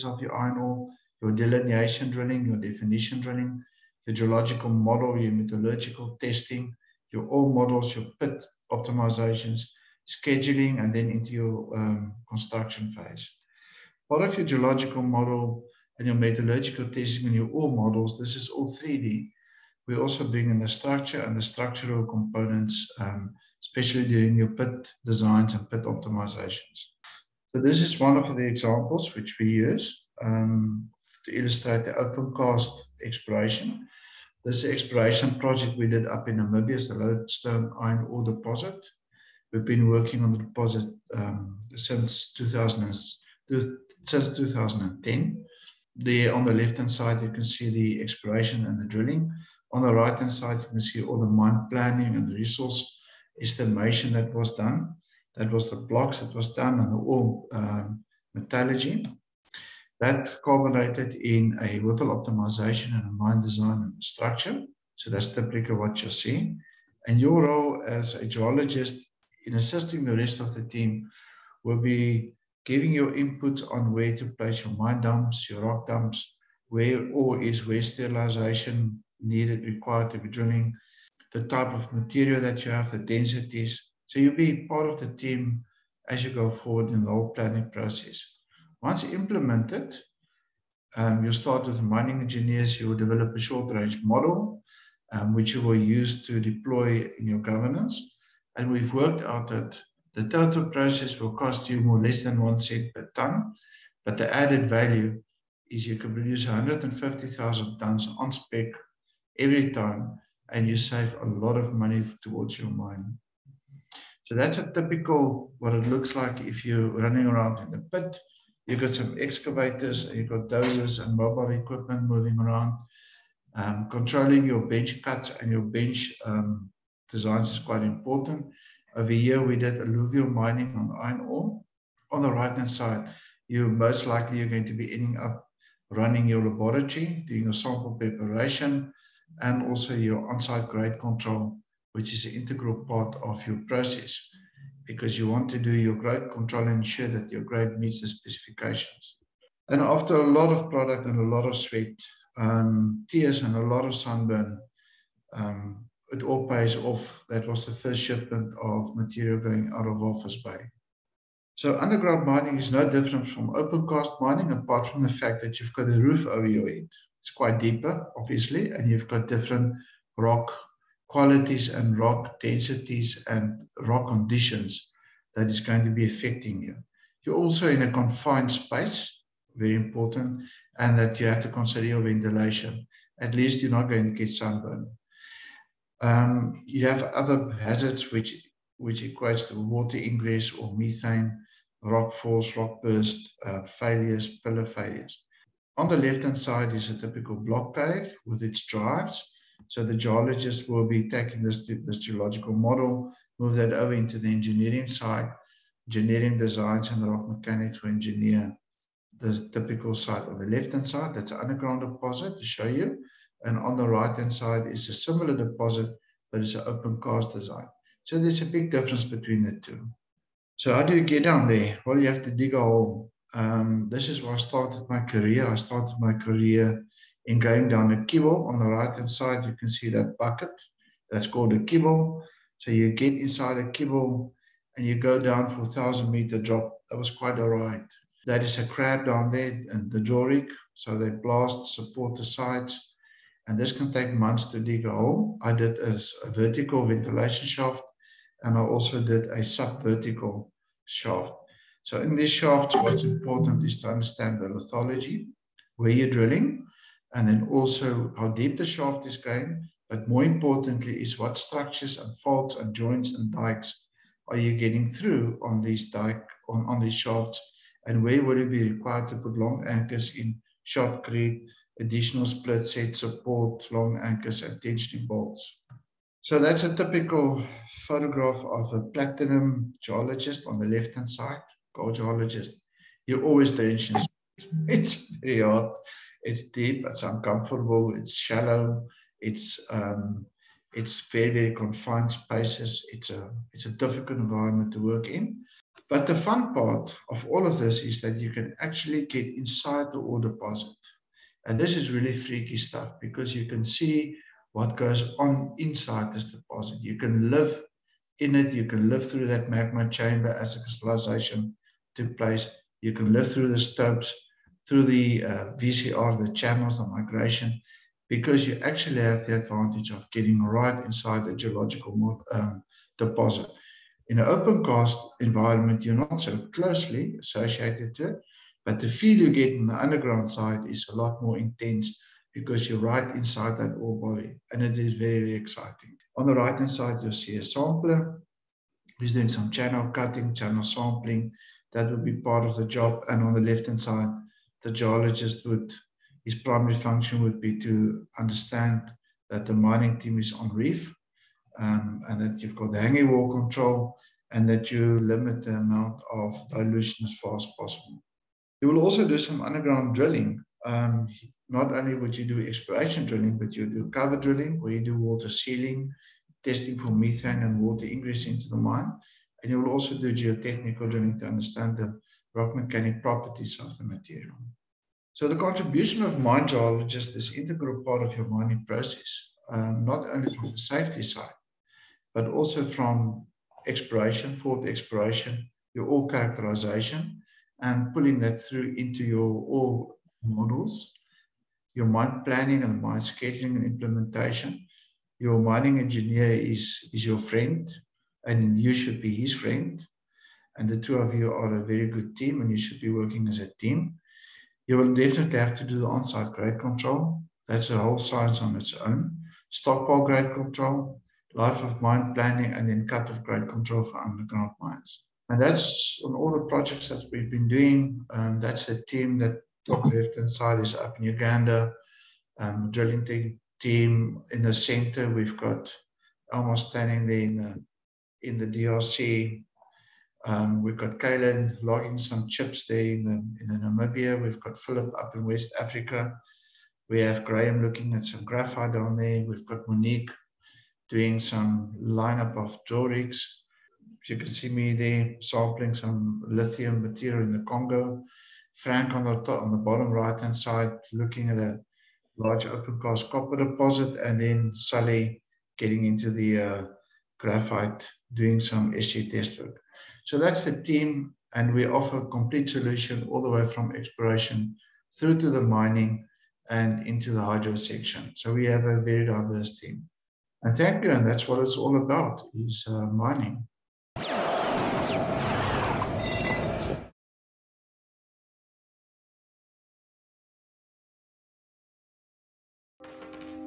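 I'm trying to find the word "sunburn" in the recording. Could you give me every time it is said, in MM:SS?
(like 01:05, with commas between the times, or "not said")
02:33, 03:04.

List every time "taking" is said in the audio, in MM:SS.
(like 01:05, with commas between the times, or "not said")
03:21.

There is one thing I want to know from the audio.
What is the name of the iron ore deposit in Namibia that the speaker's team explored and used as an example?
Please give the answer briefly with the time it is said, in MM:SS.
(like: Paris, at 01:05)
Lodestone, at 00:36.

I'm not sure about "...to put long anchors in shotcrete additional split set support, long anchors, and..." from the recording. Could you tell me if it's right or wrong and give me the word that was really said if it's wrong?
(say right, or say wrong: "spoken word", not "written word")
right.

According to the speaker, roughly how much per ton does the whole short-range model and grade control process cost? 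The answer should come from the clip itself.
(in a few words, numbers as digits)
less than one cent per ton.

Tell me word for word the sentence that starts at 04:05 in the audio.
I did a, vertical ventilation shaft and I also did a sub-vertical shaft.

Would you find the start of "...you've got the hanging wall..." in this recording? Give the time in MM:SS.
05:52.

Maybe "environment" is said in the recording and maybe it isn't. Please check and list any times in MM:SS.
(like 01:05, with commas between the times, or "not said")
04:54, 05:25.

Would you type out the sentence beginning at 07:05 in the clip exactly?
We've got almost standing there in the, in the DRC.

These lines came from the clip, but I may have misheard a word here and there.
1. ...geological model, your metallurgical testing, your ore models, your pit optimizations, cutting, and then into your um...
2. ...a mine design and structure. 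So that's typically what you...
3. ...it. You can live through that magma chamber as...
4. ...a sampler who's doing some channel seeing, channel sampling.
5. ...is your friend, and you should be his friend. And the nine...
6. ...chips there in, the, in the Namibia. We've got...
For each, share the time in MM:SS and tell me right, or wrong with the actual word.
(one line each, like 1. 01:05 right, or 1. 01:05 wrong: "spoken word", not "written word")
1. 00:04 wrong: "scheduling", not "cutting"
2. 01:03 right
3. 05:08 right
4. 05:37 wrong: "cutting", not "seeing"
5. 06:36 wrong: "two", not "nine"
6. 07:12 right.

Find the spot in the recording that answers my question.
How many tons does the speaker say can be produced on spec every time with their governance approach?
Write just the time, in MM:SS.
01:46.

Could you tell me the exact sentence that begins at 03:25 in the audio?
Engineering designs and rock mechanics will engineer the typical site on the left-hand side.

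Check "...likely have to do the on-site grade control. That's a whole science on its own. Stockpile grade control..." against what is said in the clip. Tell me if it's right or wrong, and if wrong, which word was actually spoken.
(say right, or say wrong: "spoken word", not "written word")
wrong: "definitely", not "likely".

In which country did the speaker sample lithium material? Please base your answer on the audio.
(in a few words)
Congo.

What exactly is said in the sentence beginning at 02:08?
Over here, we did alluvial mining on iron ore.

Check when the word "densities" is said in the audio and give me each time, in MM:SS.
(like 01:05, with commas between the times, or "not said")
01:22, 02:52.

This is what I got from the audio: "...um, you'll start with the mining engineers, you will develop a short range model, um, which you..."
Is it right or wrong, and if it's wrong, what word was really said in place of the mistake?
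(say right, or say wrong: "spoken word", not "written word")
right.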